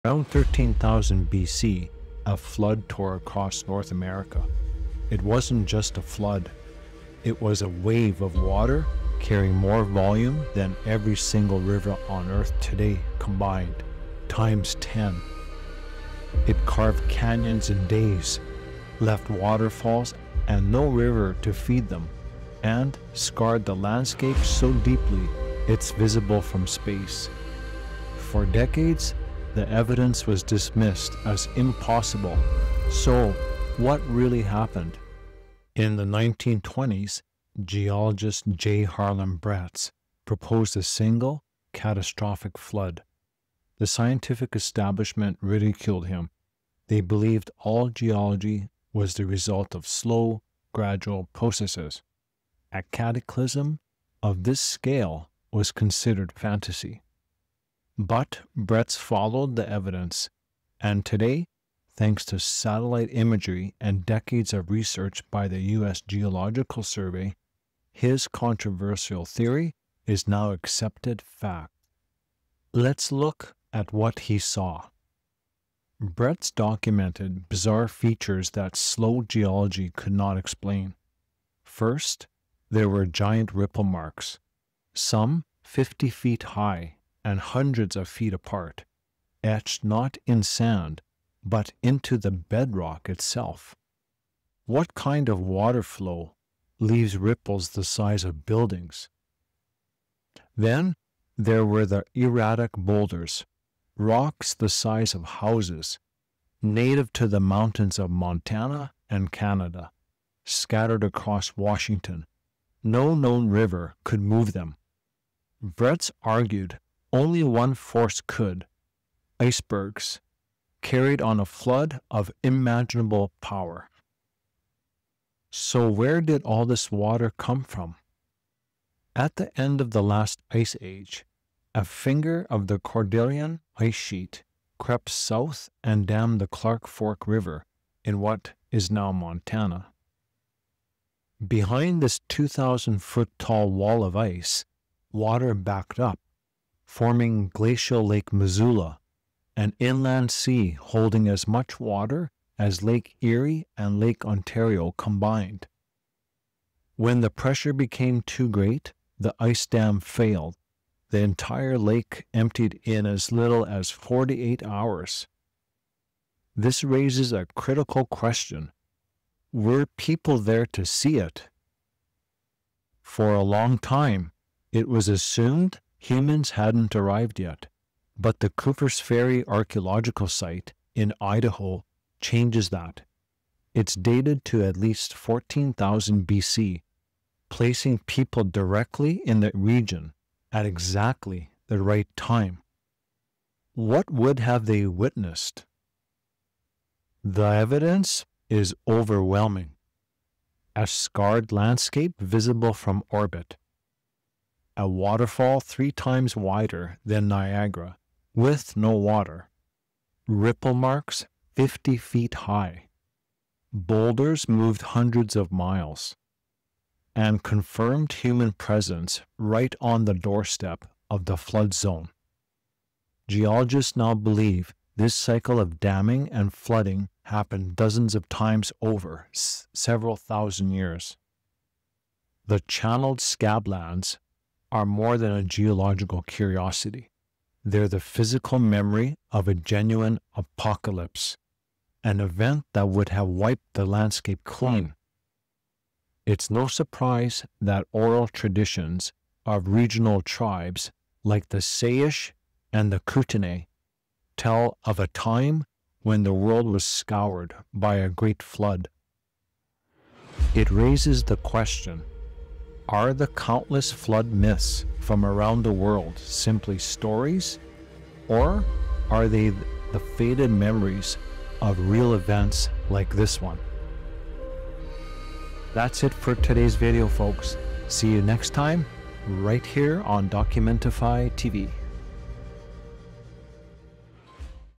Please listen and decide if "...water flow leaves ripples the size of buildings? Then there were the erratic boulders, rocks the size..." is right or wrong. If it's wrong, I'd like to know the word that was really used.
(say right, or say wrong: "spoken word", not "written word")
right.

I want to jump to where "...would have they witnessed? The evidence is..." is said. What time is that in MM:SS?
03:14.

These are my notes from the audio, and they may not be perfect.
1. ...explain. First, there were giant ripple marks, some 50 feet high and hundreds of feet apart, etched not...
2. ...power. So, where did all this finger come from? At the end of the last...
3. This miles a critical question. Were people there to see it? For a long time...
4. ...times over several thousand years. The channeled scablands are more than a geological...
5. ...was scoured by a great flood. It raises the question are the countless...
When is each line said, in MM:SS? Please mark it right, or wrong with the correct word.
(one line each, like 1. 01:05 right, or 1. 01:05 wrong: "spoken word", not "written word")
1. 01:20 right
2. 02:03 wrong: "water", not "finger"
3. 02:46 wrong: "raises", not "miles"
4. 03:48 right
5. 04:16 right.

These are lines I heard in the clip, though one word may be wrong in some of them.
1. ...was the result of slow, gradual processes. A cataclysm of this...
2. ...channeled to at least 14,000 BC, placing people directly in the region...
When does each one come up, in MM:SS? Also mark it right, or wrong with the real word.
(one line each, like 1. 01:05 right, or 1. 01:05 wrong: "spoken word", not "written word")
1. 00:48 right
2. 03:03 wrong: "dated", not "channeled".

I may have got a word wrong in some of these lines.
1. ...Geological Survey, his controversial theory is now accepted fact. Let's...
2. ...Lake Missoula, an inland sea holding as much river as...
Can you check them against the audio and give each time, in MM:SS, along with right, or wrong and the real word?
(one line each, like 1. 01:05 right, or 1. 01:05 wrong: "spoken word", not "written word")
1. 01:06 right
2. 02:28 wrong: "water", not "river".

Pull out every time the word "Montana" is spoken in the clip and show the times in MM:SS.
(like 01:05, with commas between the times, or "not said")
01:48, 02:19.